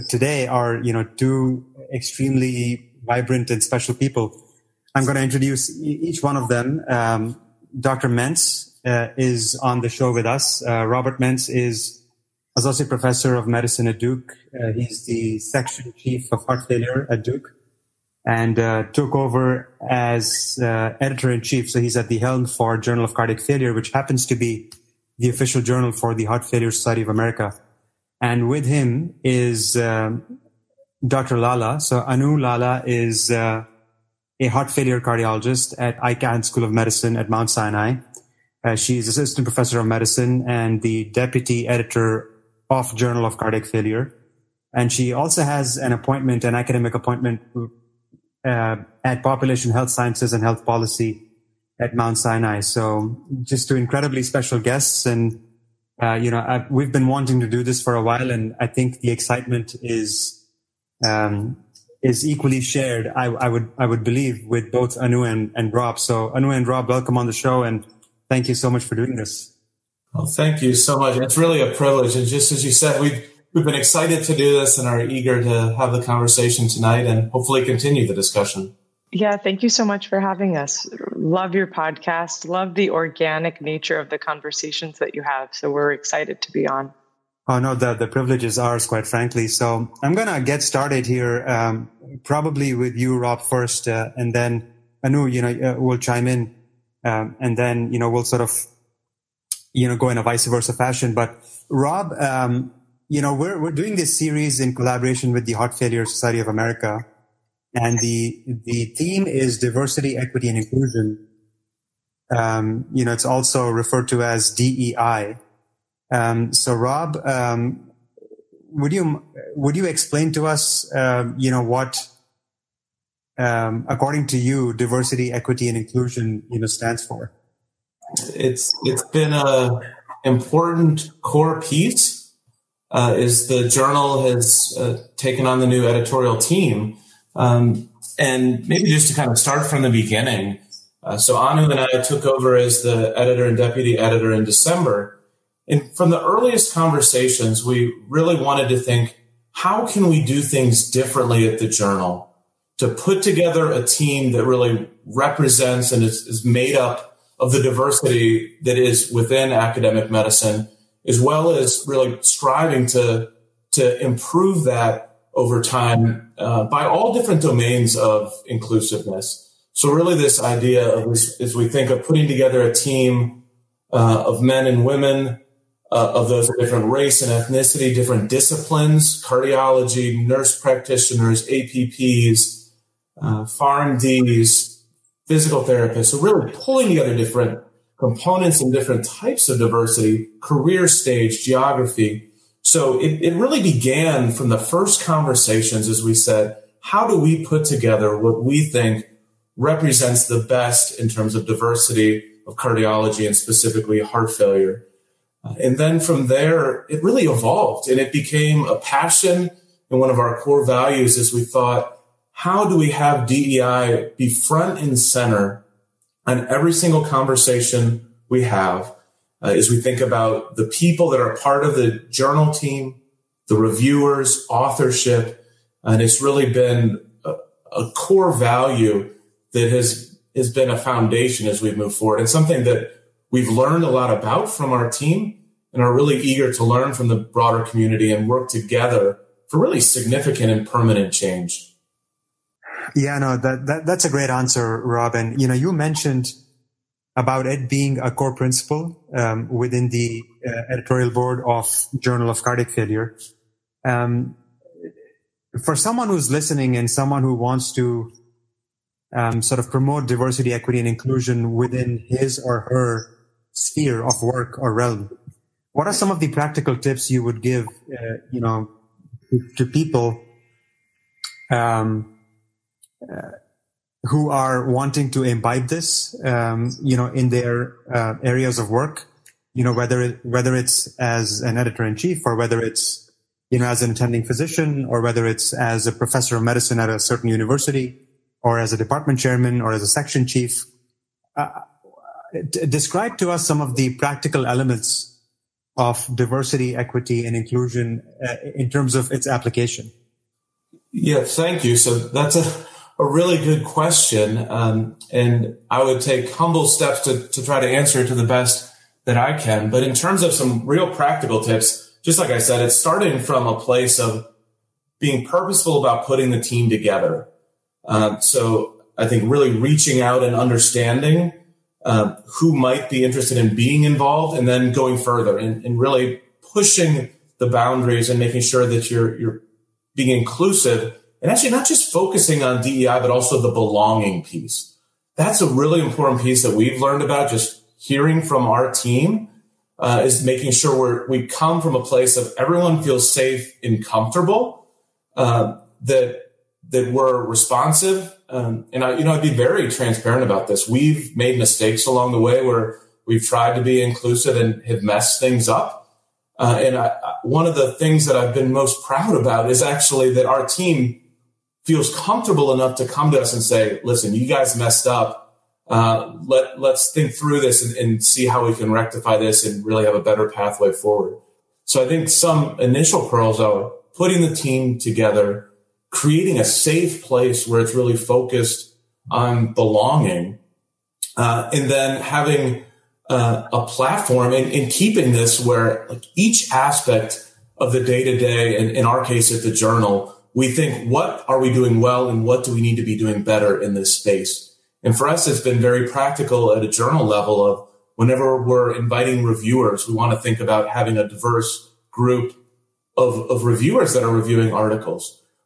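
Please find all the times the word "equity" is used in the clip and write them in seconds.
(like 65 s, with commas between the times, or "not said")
110 s, 125 s, 260 s, 296 s.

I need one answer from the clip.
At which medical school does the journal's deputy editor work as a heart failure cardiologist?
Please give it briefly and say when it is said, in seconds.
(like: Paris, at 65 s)
Icahn School of Medicine at Mount Sinai, at 35 s.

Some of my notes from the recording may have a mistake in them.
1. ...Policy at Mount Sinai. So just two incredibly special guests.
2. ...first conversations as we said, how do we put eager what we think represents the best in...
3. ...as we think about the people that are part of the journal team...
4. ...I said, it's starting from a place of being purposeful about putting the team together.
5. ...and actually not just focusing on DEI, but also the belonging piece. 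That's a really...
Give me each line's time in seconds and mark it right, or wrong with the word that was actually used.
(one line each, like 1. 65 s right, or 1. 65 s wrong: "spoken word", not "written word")
1. 50 s right
2. 194 s wrong: "together", not "eager"
3. 219 s right
4. 312 s right
5. 331 s right.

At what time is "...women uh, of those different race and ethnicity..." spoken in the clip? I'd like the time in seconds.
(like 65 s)
174 s.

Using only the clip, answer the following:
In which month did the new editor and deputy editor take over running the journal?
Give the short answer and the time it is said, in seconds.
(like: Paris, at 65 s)
December, at 144 s.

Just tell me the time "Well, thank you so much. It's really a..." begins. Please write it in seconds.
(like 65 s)
70 s.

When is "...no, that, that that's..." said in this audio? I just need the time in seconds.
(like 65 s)
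243 s.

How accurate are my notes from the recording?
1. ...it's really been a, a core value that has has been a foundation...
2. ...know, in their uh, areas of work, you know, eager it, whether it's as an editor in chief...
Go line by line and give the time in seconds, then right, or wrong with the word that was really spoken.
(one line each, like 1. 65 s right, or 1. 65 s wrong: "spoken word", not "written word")
1. 226 s right
2. 276 s wrong: "whether", not "eager".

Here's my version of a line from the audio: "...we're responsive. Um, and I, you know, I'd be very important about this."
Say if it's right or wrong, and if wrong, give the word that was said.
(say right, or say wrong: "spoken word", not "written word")
wrong: "transparent", not "important".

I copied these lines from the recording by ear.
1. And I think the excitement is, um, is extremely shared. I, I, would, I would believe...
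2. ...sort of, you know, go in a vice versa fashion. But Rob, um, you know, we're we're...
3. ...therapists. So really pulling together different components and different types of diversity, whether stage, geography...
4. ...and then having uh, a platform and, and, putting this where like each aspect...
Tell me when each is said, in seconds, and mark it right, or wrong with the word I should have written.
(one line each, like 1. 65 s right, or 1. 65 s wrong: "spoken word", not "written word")
1. 58 s wrong: "equally", not "extremely"
2. 98 s right
3. 185 s wrong: "career", not "whether"
4. 381 s wrong: "keeping", not "putting".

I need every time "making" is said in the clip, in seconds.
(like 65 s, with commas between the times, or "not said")
328 s, 340 s.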